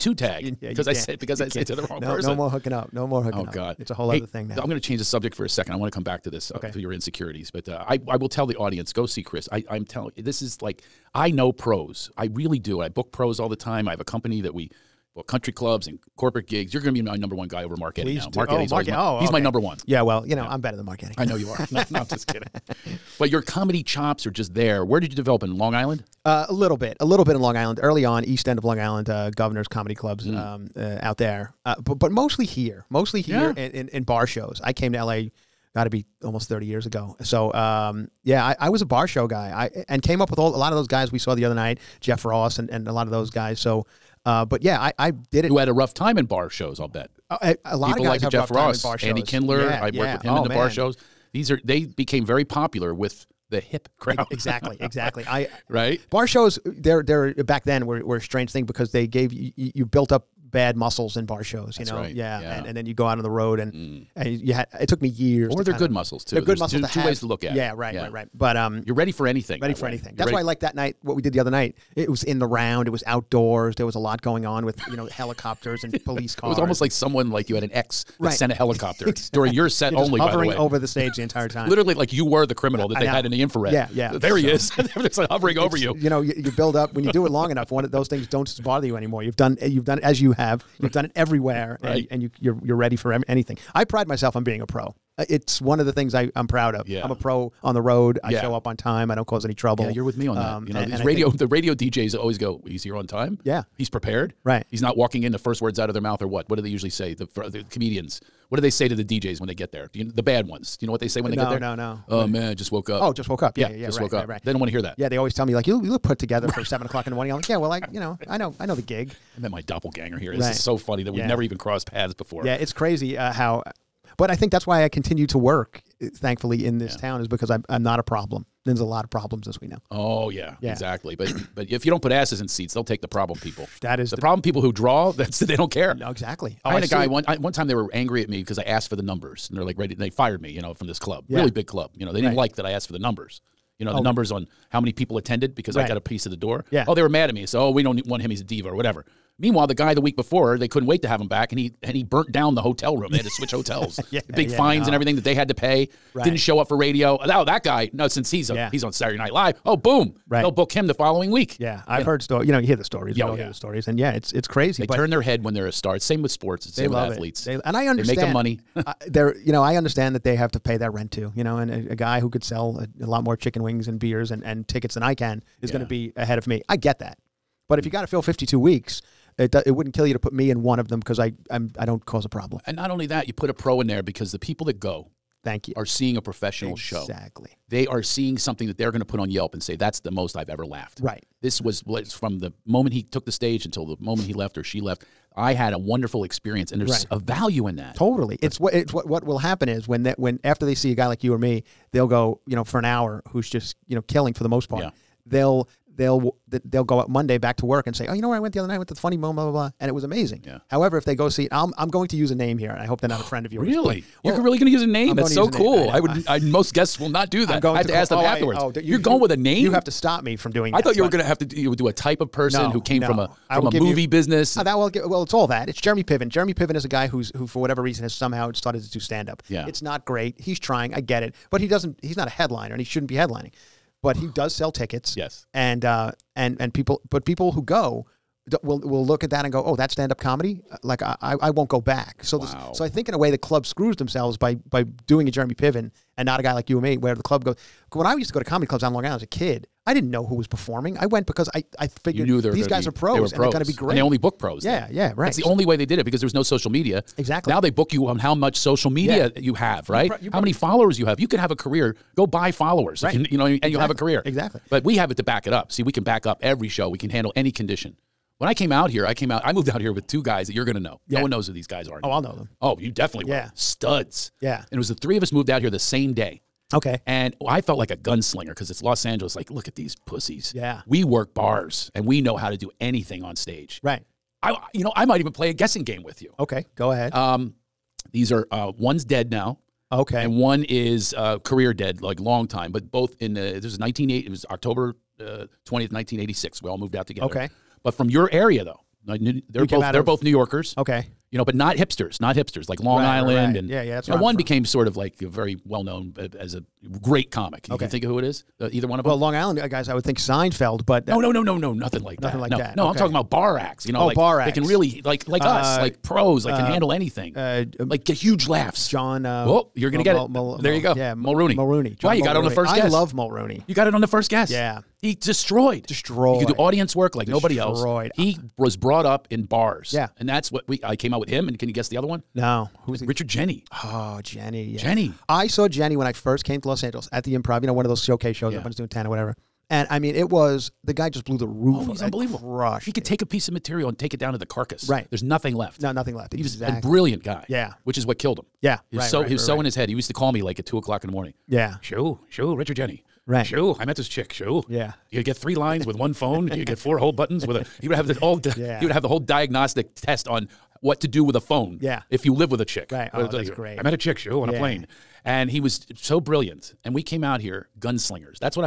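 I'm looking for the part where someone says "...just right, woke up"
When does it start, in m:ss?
1:53.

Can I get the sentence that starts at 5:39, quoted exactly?
And I mean, it was the guy just blew the roof.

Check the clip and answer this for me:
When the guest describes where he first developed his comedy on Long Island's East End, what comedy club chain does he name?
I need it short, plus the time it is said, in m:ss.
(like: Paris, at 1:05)
Governor's Comedy Clubs, at 0:29.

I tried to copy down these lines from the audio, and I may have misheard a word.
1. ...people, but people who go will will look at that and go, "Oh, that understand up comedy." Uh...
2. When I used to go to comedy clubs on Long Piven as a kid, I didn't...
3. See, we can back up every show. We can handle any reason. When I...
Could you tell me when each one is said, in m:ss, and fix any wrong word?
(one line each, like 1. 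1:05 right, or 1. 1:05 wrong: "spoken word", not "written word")
1. 3:56 wrong: "stand", not "understand"
2. 4:07 wrong: "Island", not "Piven"
3. 4:25 wrong: "condition", not "reason".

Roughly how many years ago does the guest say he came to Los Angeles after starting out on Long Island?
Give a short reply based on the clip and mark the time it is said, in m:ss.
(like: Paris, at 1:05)
almost 30 years, at 0:36.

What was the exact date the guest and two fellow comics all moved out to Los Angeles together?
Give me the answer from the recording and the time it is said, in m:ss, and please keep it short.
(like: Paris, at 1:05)
October 20th, 1986, at 4:54.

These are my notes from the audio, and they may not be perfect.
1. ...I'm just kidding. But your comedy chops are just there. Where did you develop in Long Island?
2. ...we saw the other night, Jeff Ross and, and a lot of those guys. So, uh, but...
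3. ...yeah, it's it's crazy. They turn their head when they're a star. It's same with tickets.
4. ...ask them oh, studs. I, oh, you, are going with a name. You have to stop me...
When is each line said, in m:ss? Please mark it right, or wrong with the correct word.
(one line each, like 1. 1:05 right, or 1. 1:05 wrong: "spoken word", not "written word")
1. 0:21 right
2. 0:41 right
3. 2:43 wrong: "sports", not "tickets"
4. 3:37 wrong: "afterwards", not "studs".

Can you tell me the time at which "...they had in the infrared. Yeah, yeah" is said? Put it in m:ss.
1:22.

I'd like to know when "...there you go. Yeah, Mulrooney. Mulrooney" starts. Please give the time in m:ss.
5:20.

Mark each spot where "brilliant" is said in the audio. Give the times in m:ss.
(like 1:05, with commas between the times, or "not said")
5:46, 6:06.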